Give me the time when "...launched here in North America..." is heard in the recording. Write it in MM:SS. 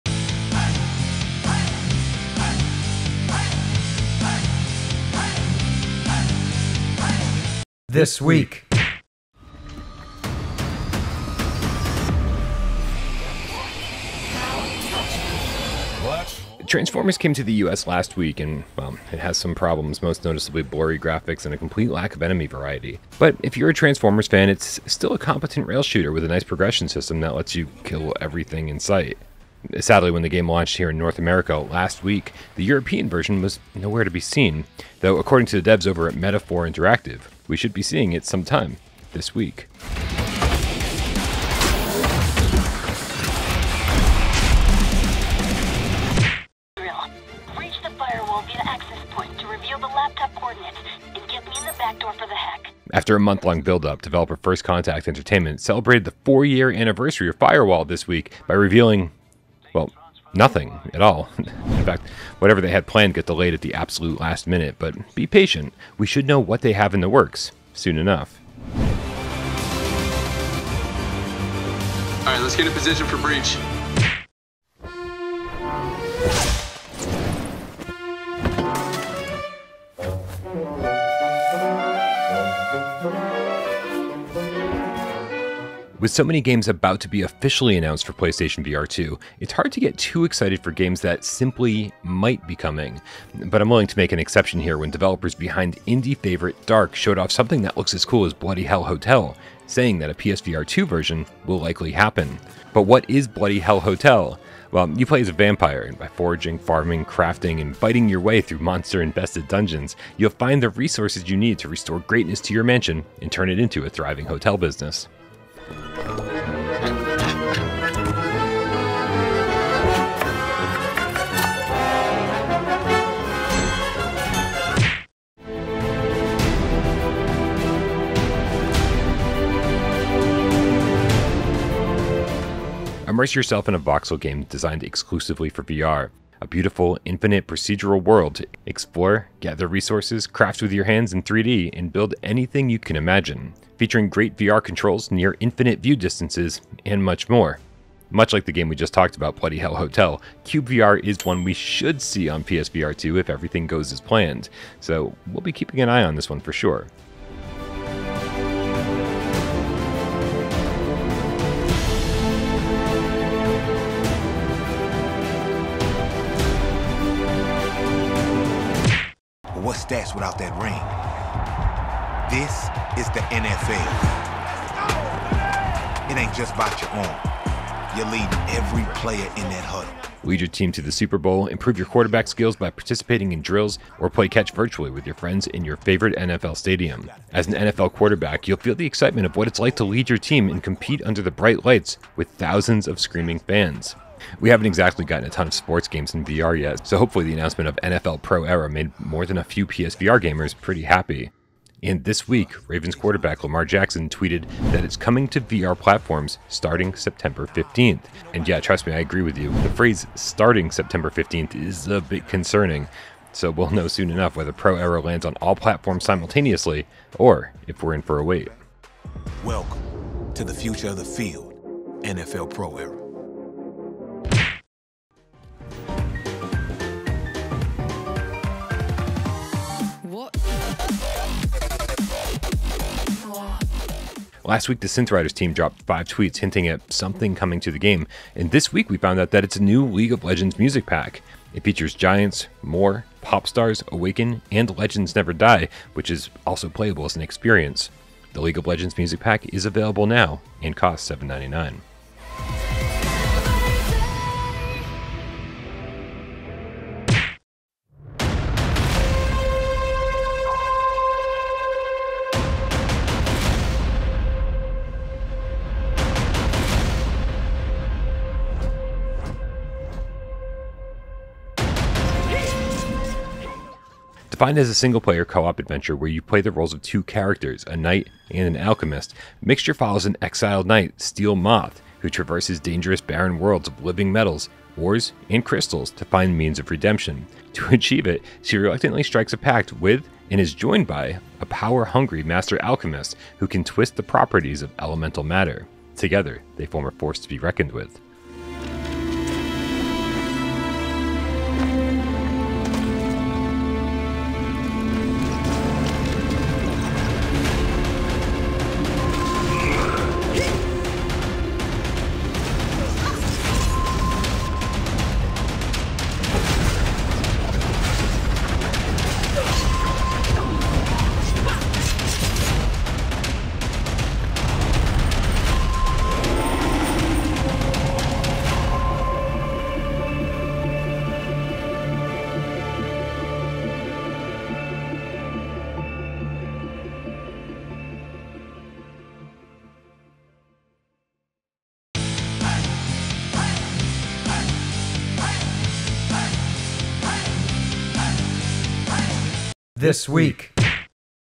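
00:30.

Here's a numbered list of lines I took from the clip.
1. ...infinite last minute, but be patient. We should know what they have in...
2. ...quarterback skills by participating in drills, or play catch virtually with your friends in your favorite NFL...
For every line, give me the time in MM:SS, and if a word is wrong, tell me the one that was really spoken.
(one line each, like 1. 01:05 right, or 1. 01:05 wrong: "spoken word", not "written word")
1. 01:03 wrong: "absolute", not "infinite"
2. 03:01 right.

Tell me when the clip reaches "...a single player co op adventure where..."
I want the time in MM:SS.
04:34.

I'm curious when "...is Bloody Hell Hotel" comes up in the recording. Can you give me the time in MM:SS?
01:43.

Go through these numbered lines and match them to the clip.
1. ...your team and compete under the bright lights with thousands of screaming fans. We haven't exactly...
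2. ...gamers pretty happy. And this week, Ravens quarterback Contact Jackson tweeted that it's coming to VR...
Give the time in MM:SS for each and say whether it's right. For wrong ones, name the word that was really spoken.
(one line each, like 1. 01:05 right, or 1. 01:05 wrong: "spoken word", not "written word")
1. 03:10 right
2. 03:20 wrong: "Lamar", not "Contact".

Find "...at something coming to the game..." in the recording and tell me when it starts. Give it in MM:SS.
03:56.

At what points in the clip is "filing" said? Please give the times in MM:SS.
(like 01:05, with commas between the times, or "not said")
not said.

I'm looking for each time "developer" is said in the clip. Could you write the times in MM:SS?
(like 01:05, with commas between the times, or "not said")
00:54, 01:34.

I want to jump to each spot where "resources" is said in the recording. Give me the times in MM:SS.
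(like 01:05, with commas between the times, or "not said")
01:50, 02:19.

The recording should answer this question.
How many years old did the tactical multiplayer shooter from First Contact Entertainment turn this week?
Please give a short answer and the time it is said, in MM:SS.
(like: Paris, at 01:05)
4, at 00:56.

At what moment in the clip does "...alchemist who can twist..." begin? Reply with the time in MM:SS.
04:52.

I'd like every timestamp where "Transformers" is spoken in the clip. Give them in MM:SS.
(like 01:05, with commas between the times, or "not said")
00:16, 00:23.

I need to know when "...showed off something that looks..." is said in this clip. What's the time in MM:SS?
01:36.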